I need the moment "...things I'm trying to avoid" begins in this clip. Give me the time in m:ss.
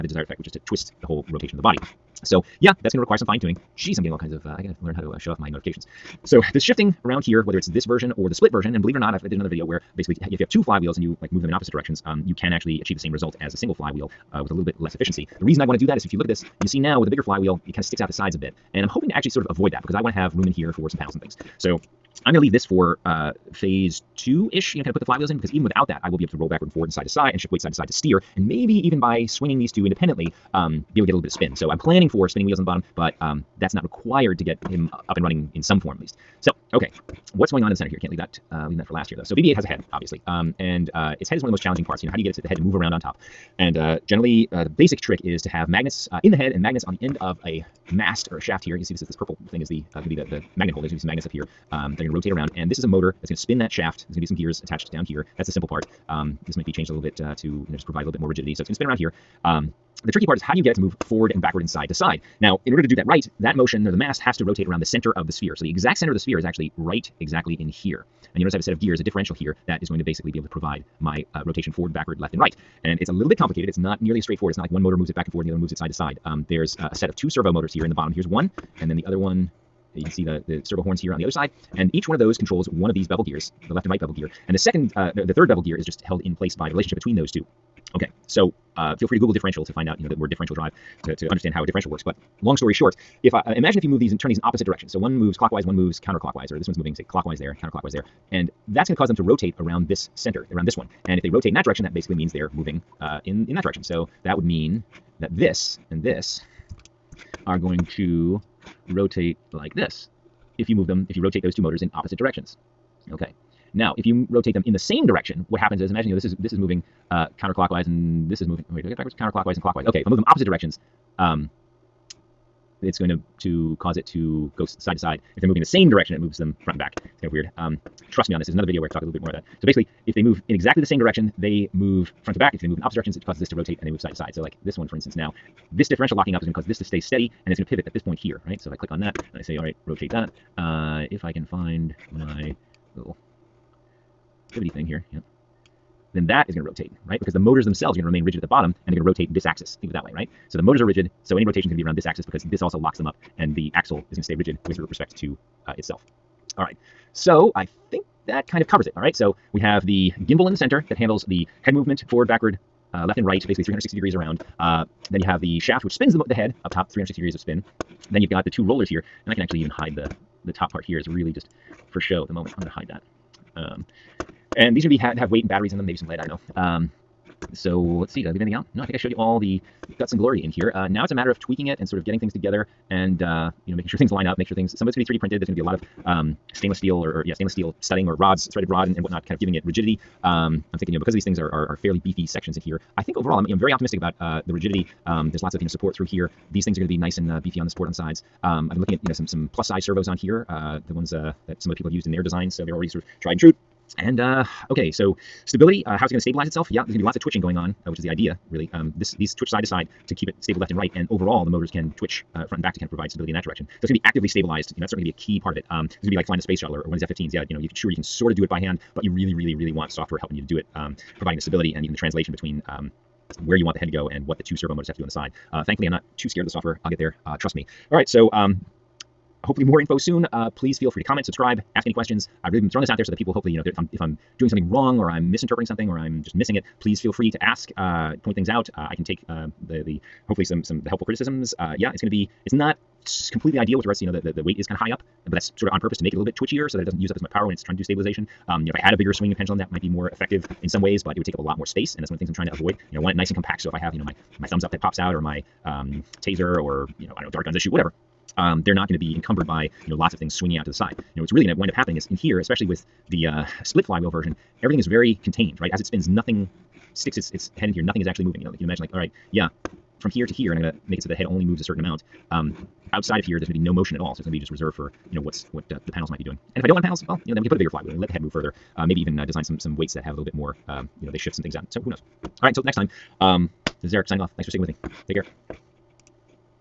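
4:12.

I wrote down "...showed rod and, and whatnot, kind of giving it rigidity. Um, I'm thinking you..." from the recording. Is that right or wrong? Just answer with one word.
wrong.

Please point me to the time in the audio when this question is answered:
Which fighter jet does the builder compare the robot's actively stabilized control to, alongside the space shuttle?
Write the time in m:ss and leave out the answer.
3:37.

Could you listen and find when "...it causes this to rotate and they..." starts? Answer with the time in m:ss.
2:13.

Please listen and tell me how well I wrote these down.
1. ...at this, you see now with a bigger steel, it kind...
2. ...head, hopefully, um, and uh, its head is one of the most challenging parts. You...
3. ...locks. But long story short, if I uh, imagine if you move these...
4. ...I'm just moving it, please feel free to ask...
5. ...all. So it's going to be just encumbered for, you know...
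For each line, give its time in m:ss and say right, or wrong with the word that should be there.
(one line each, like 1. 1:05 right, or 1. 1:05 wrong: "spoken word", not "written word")
1. 0:16 wrong: "flywheel", not "steel"
2. 0:39 wrong: "obviously", not "hopefully"
3. 1:31 wrong: "works", not "locks"
4. 3:55 wrong: "missing", not "moving"
5. 4:33 wrong: "reserved", not "encumbered".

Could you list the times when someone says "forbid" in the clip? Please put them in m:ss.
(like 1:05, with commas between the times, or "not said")
not said.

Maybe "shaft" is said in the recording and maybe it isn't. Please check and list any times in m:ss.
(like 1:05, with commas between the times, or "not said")
0:48, 0:53, 2:45.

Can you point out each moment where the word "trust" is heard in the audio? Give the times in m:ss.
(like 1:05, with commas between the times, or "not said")
2:08, 3:47.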